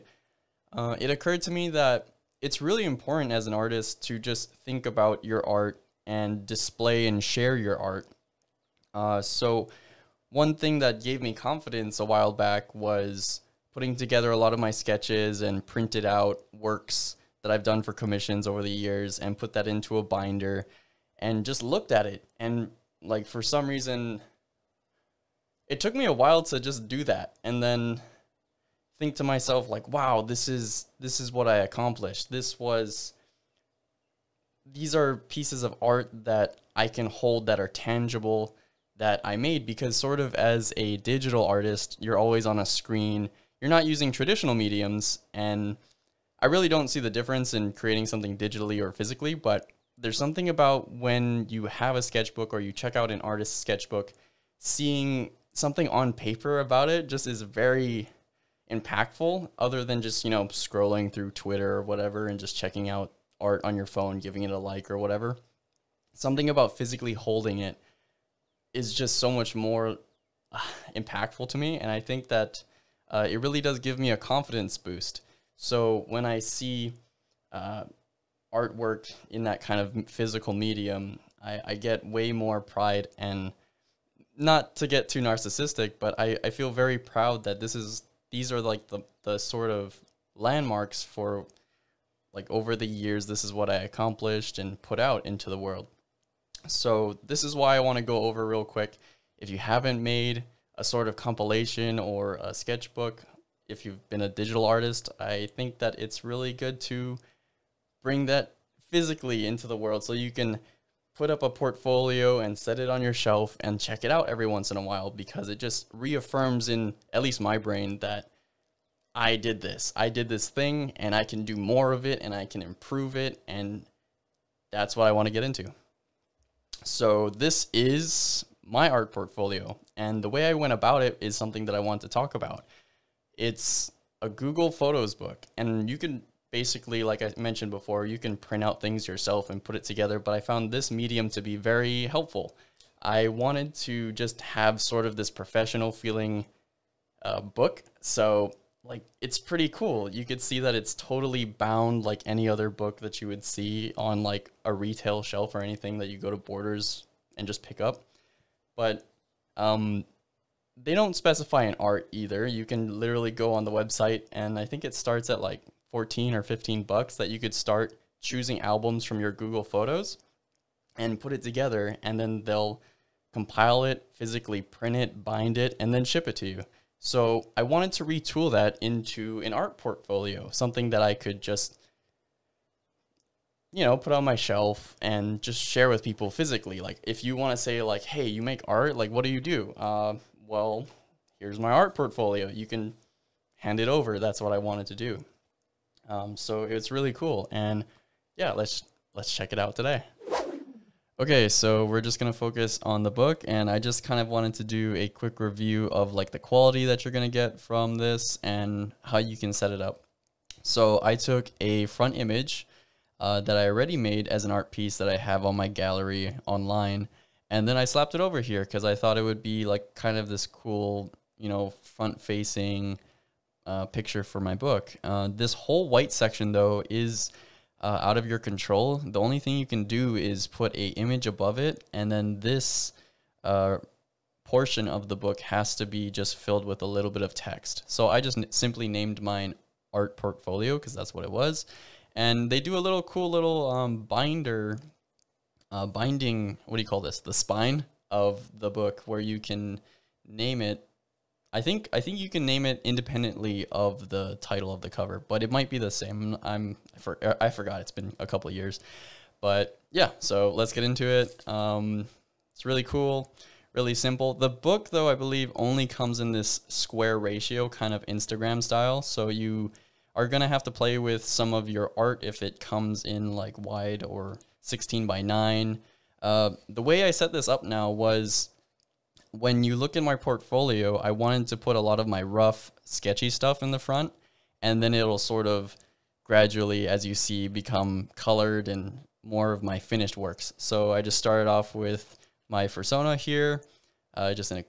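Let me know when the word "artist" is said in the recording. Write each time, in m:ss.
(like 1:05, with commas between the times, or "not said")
0:03, 0:41, 0:53, 1:44.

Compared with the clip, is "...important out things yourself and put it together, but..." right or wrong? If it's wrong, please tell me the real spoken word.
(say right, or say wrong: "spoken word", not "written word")
wrong: "print", not "important".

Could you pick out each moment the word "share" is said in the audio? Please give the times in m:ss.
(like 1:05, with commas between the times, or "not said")
0:07, 3:05.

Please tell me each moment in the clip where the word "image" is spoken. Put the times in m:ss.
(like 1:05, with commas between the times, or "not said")
3:32, 3:50.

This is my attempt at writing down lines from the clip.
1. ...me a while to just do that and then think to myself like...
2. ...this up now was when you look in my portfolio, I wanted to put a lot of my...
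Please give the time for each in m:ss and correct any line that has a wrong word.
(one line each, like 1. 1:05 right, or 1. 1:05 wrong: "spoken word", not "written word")
1. 0:25 right
2. 4:37 right.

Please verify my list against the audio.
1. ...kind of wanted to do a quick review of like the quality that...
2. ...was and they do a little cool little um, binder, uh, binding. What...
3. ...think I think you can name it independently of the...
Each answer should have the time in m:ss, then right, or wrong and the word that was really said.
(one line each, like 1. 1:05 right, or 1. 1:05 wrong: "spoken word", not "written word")
1. 3:24 right
2. 4:01 right
3. 4:11 right.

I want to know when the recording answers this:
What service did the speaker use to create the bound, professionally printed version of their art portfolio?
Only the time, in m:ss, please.
2:14.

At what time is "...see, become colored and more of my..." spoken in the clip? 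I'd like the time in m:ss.
4:47.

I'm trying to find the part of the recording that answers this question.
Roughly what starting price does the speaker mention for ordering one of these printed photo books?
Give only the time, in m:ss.
2:45.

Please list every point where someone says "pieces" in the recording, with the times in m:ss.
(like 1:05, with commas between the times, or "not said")
0:35, 3:34.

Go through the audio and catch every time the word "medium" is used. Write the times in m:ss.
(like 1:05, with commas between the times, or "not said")
0:44, 1:20, 2:20.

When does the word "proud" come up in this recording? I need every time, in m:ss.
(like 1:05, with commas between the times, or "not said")
1:26.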